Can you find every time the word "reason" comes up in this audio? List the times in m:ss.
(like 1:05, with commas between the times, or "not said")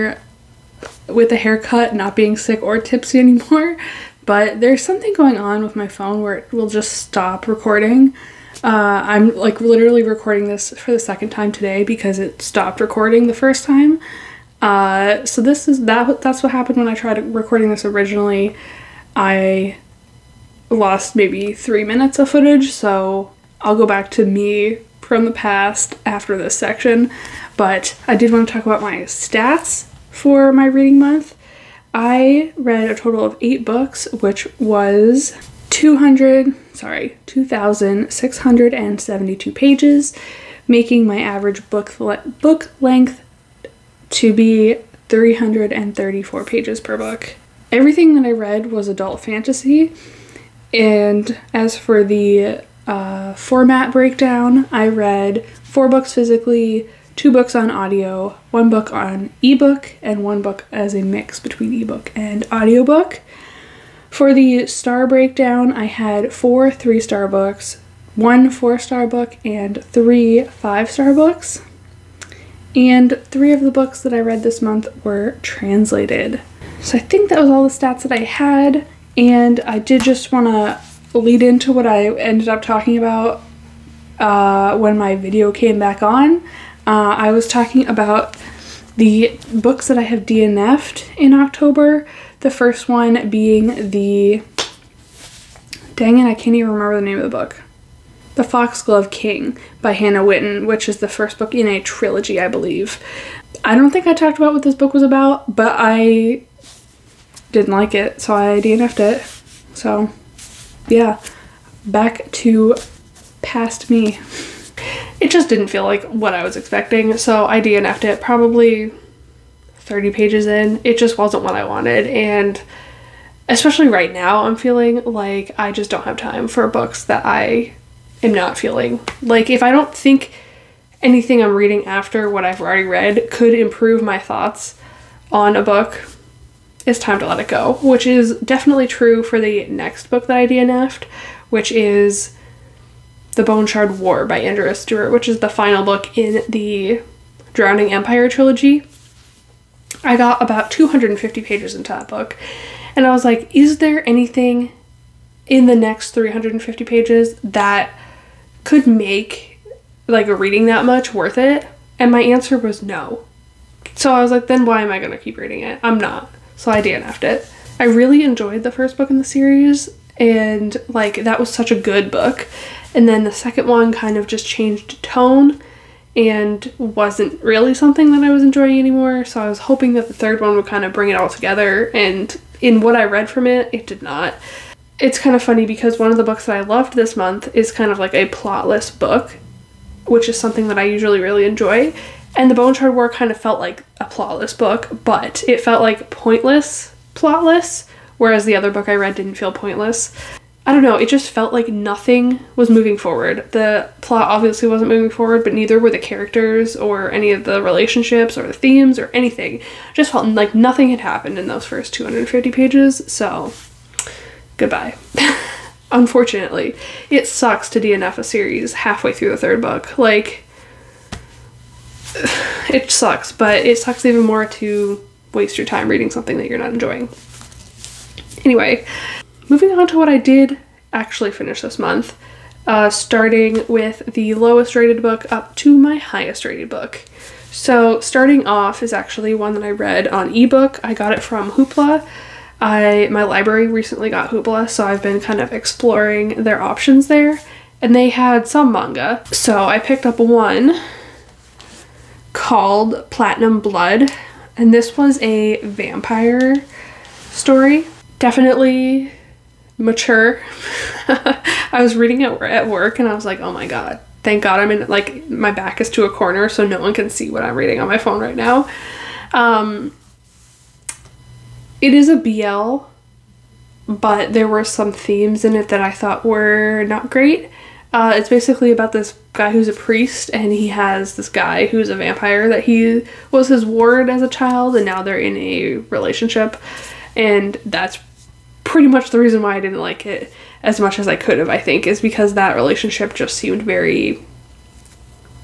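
4:49.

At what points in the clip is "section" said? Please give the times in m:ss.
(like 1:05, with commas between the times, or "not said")
0:26.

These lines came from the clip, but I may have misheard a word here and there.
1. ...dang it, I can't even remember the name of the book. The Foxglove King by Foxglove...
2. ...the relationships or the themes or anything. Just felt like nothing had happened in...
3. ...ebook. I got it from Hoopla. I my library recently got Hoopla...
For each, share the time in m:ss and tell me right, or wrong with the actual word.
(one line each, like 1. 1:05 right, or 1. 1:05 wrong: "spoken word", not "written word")
1. 1:35 wrong: "Hannah", not "Foxglove"
2. 3:27 right
3. 4:00 right.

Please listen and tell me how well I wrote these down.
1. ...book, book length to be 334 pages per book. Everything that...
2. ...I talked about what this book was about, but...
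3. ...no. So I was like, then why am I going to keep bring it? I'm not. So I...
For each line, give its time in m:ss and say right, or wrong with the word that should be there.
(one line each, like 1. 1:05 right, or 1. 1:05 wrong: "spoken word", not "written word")
1. 0:41 right
2. 1:44 right
3. 2:42 wrong: "reading", not "bring".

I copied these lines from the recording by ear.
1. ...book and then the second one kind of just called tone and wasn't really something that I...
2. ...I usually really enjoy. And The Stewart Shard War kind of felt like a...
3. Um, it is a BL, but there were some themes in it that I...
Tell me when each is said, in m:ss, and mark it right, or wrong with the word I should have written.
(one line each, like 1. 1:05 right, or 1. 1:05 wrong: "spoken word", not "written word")
1. 2:52 wrong: "changed", not "called"
2. 3:10 wrong: "Bone", not "Stewart"
3. 4:29 right.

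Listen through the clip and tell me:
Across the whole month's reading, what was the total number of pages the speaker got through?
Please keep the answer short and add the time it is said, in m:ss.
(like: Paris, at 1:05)
2,672, at 0:37.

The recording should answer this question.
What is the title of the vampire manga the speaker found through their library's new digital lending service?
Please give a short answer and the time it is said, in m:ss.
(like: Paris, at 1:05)
Platinum Blood, at 4:13.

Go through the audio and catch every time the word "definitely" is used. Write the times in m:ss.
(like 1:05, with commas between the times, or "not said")
2:18, 4:18.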